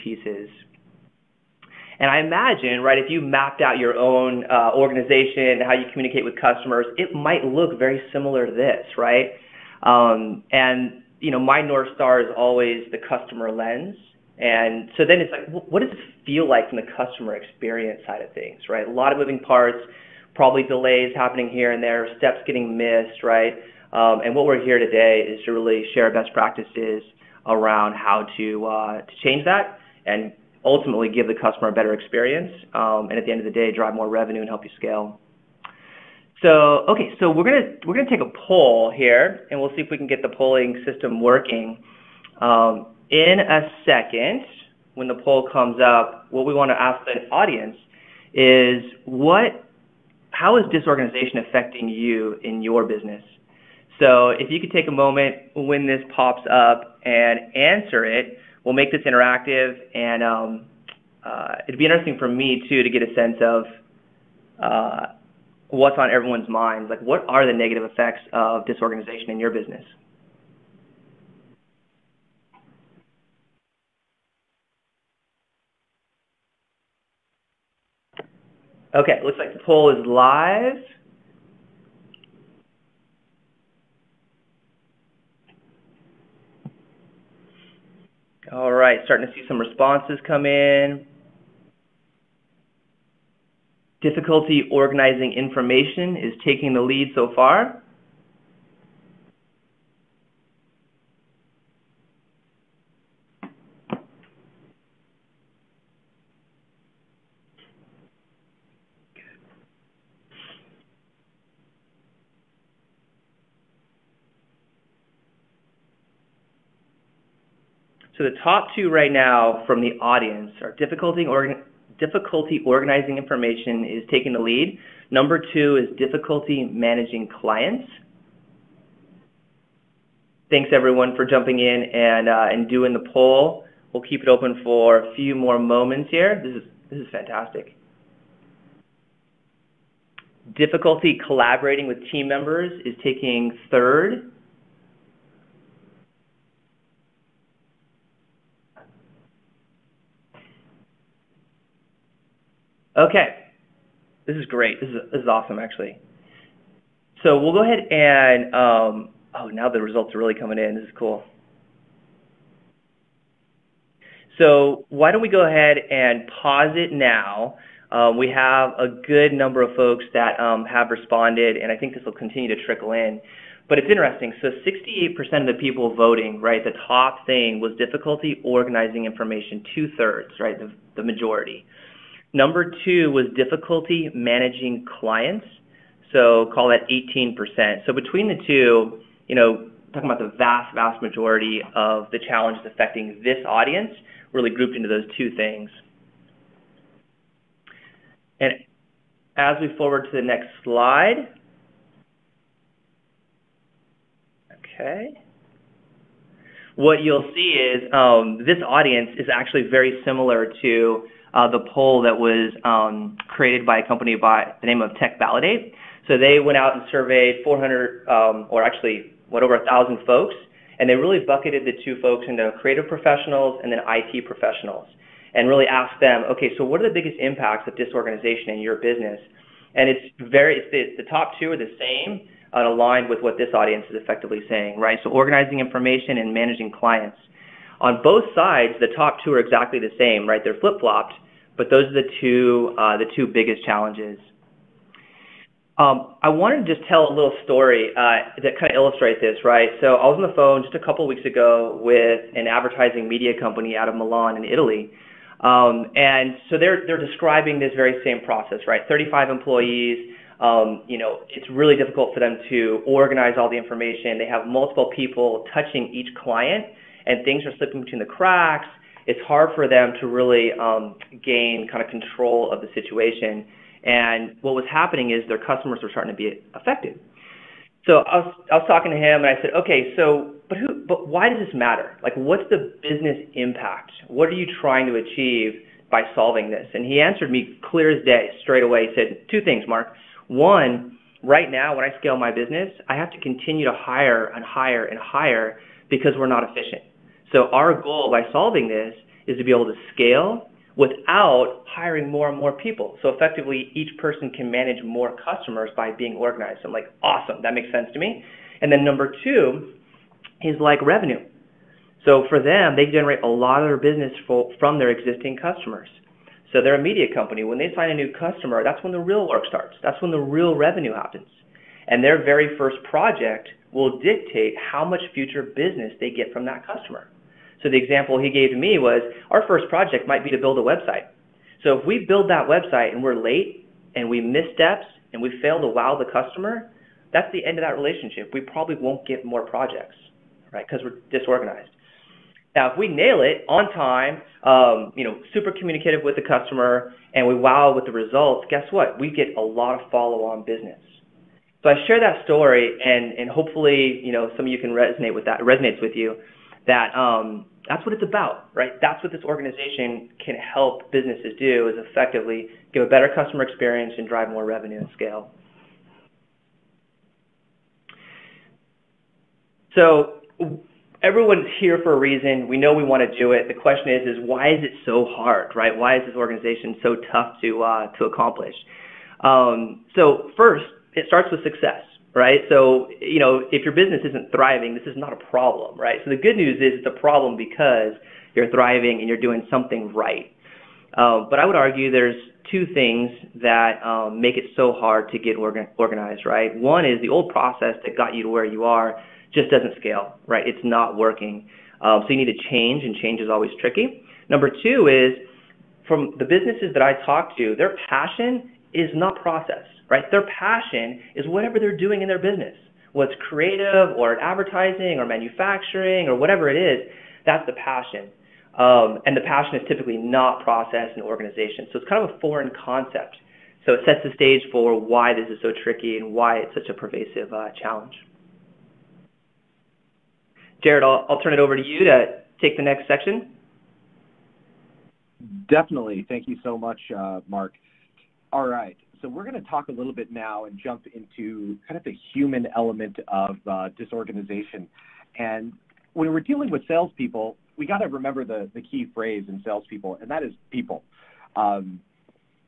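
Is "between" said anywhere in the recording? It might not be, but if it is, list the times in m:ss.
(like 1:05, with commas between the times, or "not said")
3:07, 4:27.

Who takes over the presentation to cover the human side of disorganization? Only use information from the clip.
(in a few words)
Jared.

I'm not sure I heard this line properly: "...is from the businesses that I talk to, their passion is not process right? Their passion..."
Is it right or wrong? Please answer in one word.
right.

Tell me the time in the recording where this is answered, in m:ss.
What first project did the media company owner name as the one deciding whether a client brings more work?
5:30.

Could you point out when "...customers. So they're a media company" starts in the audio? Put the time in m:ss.
5:15.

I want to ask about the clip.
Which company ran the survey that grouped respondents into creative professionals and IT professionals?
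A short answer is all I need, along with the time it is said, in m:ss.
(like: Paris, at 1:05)
TechValidate, at 3:34.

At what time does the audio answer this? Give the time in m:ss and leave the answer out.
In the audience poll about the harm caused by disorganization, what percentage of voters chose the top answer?
2:54.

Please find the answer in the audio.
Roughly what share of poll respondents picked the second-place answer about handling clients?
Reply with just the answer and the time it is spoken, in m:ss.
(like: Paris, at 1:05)
18%, at 3:06.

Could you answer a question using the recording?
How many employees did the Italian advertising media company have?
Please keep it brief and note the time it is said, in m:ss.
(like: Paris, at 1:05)
35, at 4:18.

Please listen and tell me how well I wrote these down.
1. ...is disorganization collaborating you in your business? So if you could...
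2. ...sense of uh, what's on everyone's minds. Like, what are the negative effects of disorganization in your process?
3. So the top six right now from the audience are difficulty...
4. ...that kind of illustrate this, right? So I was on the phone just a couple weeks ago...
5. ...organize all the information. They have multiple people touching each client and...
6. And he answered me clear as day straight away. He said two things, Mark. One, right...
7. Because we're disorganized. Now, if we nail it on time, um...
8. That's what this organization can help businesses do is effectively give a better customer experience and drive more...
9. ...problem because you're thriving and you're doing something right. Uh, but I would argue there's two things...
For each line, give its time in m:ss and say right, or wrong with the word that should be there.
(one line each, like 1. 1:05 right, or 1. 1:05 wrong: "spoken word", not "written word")
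1. 0:50 wrong: "affecting", not "collaborating"
2. 1:03 wrong: "business", not "process"
3. 1:58 wrong: "two", not "six"
4. 4:08 right
5. 4:22 right
6. 4:46 right
7. 5:40 right
8. 5:58 right
9. 6:26 right.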